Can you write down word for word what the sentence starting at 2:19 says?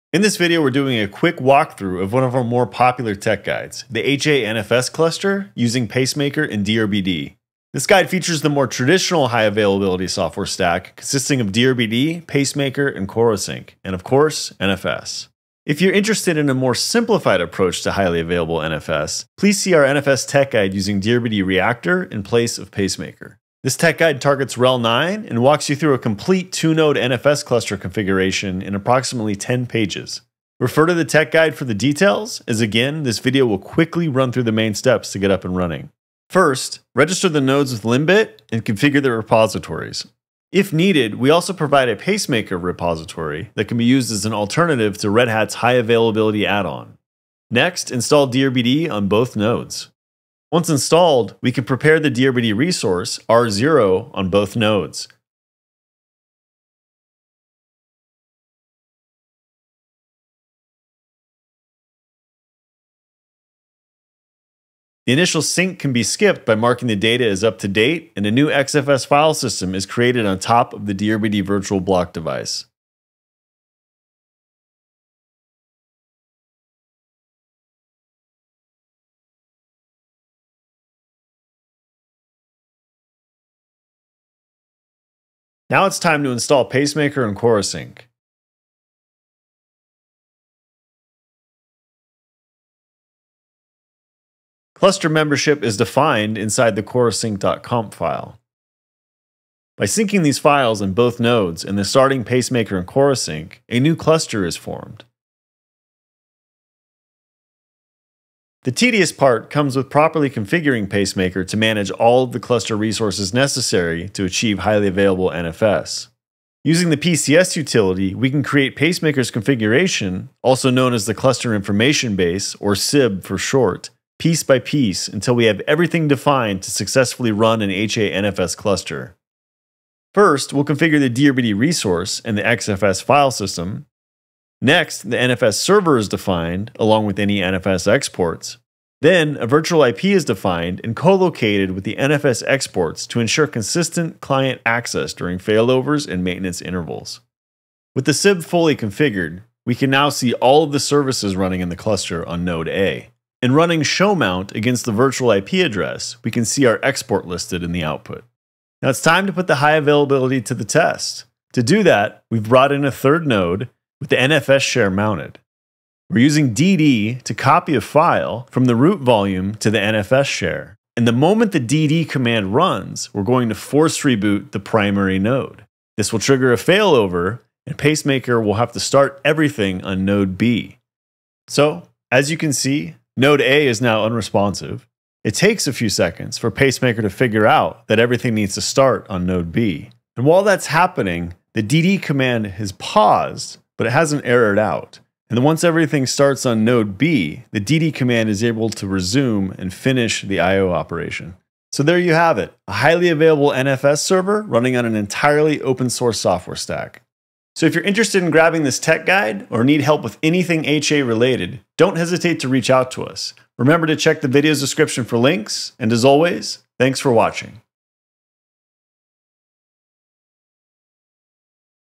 Then, a virtual IP is defined and co-located with the NFS exports to ensure consistent client access during failovers and maintenance intervals.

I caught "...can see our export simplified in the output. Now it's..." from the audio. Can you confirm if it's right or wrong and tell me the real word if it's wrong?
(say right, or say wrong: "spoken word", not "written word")
wrong: "listed", not "simplified".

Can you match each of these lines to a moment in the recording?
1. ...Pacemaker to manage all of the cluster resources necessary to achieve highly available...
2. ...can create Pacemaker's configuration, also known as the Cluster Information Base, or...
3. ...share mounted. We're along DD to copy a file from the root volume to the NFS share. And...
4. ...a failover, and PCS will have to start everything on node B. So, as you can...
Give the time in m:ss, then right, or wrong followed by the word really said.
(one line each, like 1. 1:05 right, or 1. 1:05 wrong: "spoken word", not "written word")
1. 1:50 right
2. 1:58 right
3. 2:44 wrong: "using", not "along"
4. 2:56 wrong: "Pacemaker", not "PCS".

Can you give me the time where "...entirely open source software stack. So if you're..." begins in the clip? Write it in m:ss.
3:24.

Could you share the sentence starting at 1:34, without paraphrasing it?
Cluster membership is defined inside the corosync.conf file.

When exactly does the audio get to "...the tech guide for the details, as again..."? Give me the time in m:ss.
0:30.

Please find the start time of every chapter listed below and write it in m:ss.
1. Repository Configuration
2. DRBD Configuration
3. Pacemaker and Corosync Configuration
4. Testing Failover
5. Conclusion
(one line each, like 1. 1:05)
1. 0:35
2. 0:49
3. 1:25
4. 2:37
5. 3:21.